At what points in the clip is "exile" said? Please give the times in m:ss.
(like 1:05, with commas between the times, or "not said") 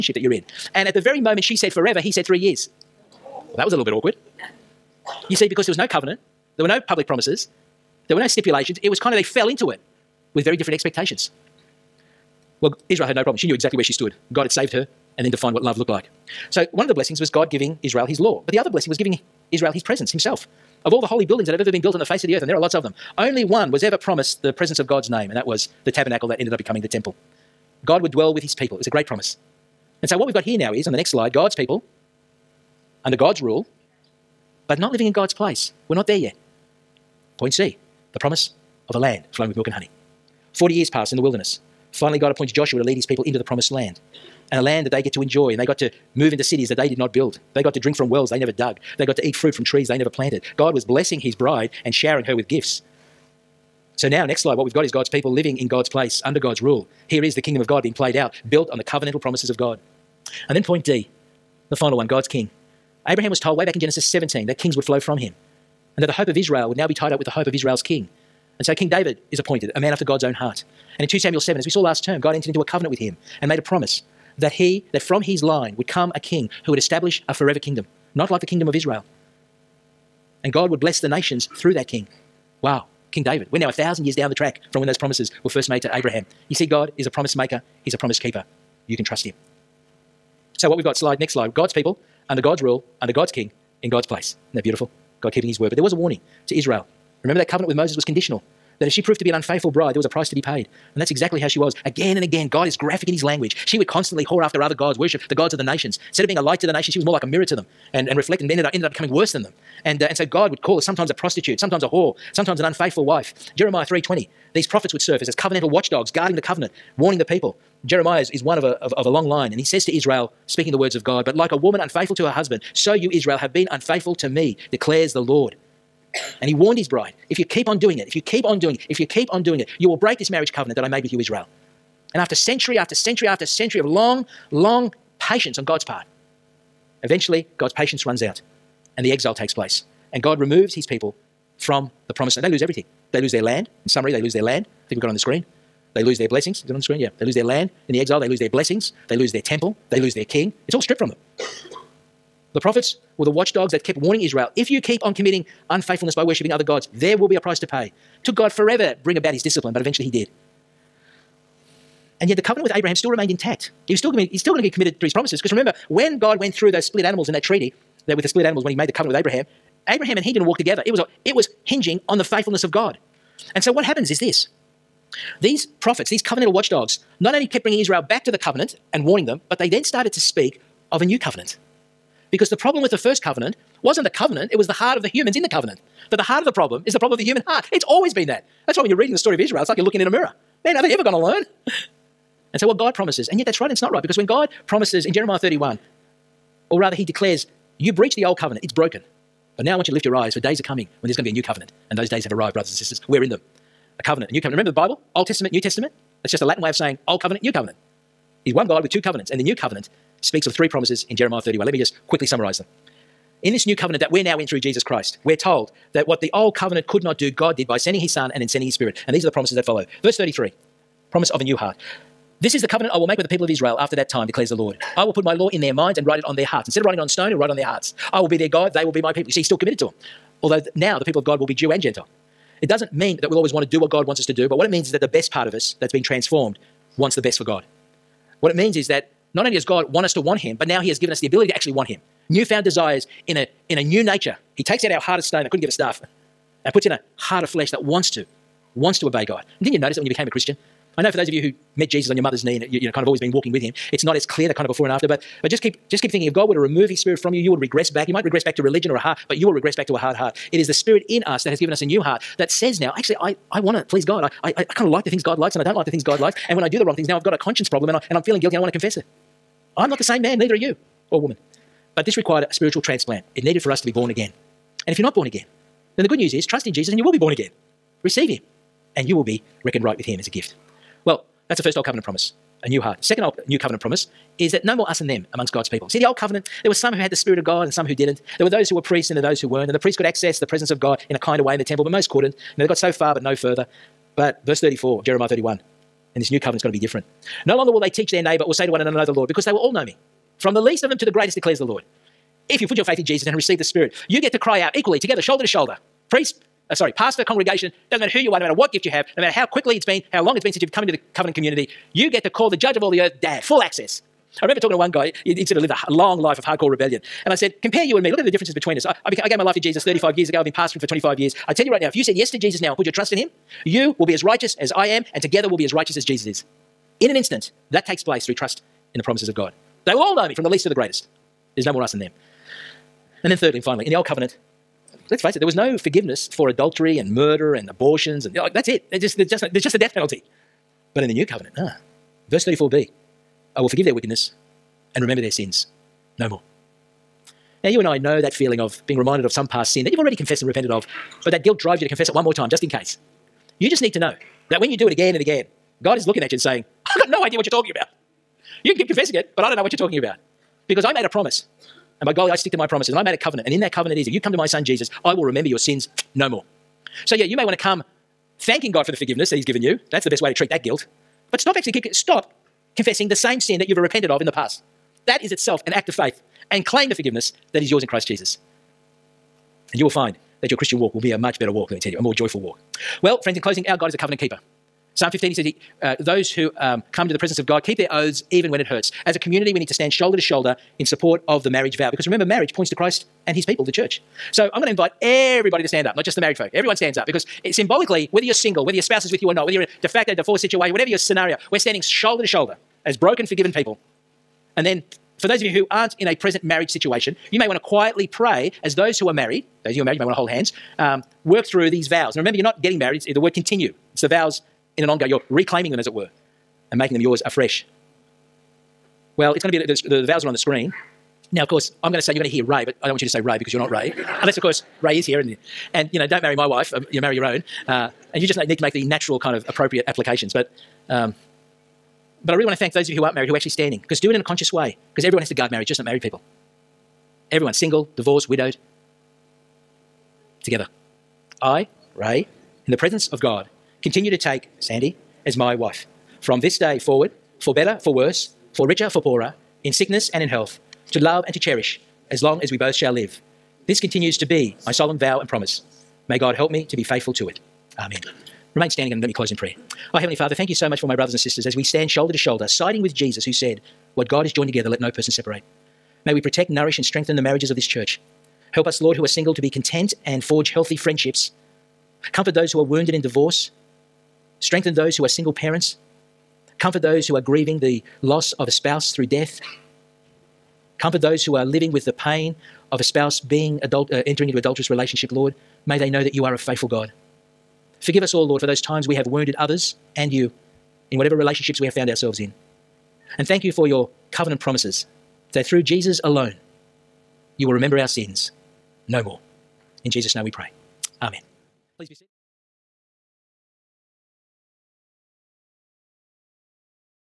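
2:19, 2:28.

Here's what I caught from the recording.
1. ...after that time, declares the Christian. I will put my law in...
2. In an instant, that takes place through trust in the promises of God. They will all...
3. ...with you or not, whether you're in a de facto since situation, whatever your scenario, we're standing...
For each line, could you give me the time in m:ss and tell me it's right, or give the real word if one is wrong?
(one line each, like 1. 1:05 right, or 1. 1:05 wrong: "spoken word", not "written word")
1. 3:43 wrong: "Lord", not "Christian"
2. 5:27 right
3. 6:39 wrong: "divorce", not "since".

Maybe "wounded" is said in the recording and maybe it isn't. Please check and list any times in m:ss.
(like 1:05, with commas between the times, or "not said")
7:52, 8:09.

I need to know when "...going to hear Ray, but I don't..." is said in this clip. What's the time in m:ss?
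7:02.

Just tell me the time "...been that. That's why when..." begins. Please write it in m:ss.
3:08.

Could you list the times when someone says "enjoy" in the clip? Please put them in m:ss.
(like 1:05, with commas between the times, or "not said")
0:45.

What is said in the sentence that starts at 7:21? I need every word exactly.
I, Ray, in the presence of God, continue to take Sandy as my wife.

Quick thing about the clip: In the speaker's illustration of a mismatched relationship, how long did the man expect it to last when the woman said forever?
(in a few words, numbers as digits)
3 years.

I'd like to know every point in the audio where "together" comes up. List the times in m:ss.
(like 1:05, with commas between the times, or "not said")
2:50, 5:04, 5:25, 7:20, 7:44.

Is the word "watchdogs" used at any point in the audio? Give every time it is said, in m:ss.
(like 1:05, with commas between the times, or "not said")
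1:55, 2:33, 2:56.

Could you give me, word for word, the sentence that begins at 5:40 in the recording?
But in the New Covenant, ah, verse 34b I will forgive their wickedness and remember their sins no more.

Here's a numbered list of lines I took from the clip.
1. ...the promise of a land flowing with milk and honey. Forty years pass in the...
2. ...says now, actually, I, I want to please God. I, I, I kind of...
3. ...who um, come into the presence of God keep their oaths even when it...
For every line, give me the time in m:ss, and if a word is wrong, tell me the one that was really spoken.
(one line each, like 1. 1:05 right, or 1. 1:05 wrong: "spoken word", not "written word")
1. 0:38 right
2. 4:22 right
3. 6:26 right.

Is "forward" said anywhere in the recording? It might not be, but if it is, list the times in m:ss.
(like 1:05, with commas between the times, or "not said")
7:26.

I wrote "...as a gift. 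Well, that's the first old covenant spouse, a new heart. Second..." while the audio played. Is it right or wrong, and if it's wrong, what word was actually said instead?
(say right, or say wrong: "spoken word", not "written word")
wrong: "promise", not "spouse".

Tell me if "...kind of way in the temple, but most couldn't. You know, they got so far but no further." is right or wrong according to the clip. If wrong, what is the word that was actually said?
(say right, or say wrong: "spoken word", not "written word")
right.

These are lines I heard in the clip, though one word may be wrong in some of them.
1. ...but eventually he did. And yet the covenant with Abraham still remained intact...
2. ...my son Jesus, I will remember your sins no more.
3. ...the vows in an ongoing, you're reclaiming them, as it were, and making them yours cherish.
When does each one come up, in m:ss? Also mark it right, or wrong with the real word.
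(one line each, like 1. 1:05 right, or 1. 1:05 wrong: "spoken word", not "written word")
1. 2:39 right
2. 6:04 right
3. 6:54 wrong: "afresh", not "cherish".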